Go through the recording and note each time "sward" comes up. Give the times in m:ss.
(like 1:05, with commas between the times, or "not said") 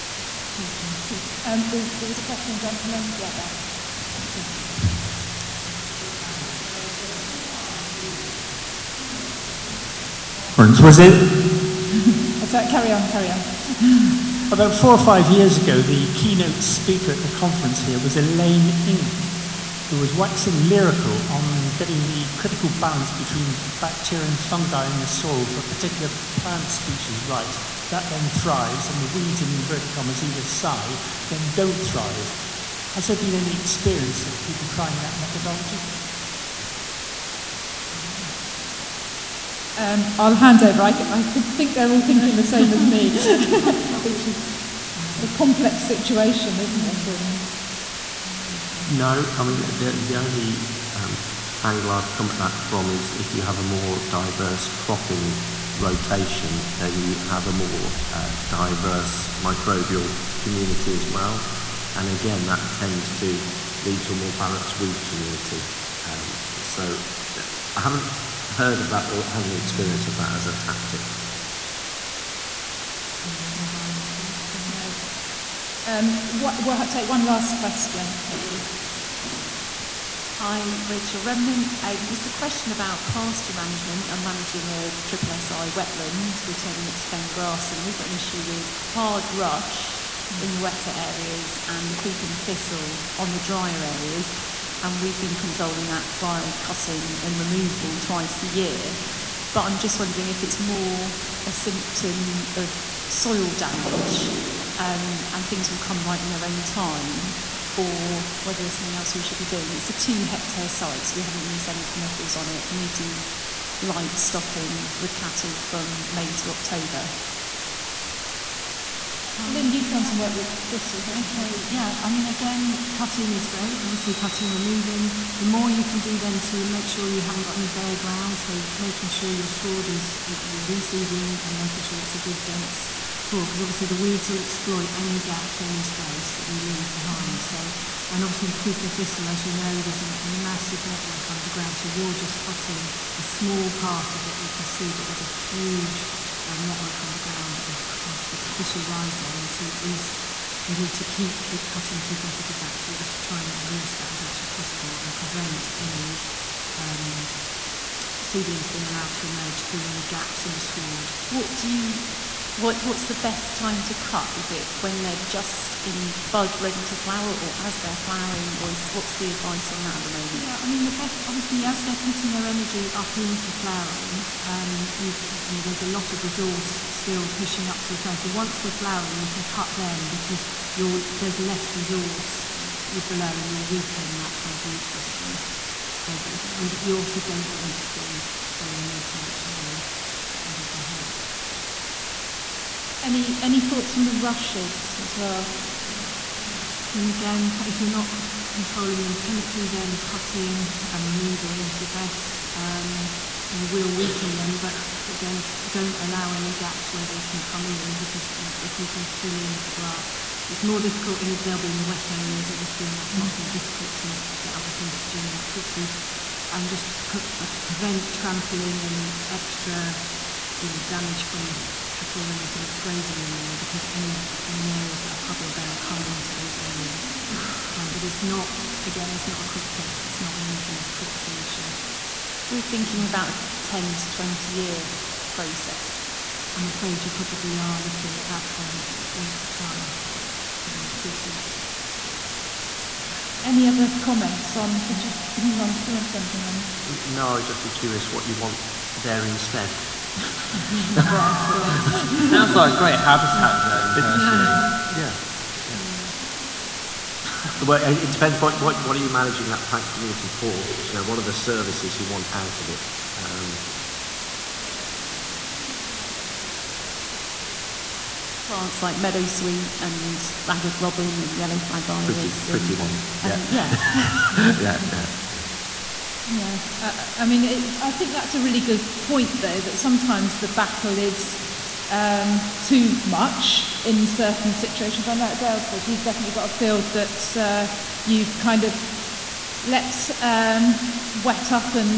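2:09, 2:40.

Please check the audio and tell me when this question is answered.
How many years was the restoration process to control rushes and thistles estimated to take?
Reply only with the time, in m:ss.
3:53.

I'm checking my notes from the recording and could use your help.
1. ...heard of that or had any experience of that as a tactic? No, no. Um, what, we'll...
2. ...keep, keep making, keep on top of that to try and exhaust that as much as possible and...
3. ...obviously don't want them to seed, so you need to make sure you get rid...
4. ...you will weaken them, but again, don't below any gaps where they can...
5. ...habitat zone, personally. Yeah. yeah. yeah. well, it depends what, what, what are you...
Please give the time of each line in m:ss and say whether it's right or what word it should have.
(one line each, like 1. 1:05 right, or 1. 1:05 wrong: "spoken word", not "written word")
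1. 1:08 right
2. 2:31 wrong: "cutting", not "making"
3. 3:06 right
4. 3:23 wrong: "allow", not "below"
5. 4:12 right.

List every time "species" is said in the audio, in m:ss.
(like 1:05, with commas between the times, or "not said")
0:26, 4:00.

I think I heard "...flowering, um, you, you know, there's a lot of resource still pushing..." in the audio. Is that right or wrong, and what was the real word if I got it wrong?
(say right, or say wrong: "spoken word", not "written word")
right.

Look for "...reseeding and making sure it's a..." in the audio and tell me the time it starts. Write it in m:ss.
2:10.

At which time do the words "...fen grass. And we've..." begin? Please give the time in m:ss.
1:27.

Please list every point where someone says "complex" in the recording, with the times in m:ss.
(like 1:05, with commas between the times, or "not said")
0:45.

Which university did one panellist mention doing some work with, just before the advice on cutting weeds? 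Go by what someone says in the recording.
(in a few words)
Bristol.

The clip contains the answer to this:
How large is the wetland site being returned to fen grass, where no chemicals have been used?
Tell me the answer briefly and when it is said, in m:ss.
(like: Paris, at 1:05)
2 hectares, at 1:49.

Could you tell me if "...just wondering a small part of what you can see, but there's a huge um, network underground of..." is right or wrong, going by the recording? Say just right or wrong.
wrong.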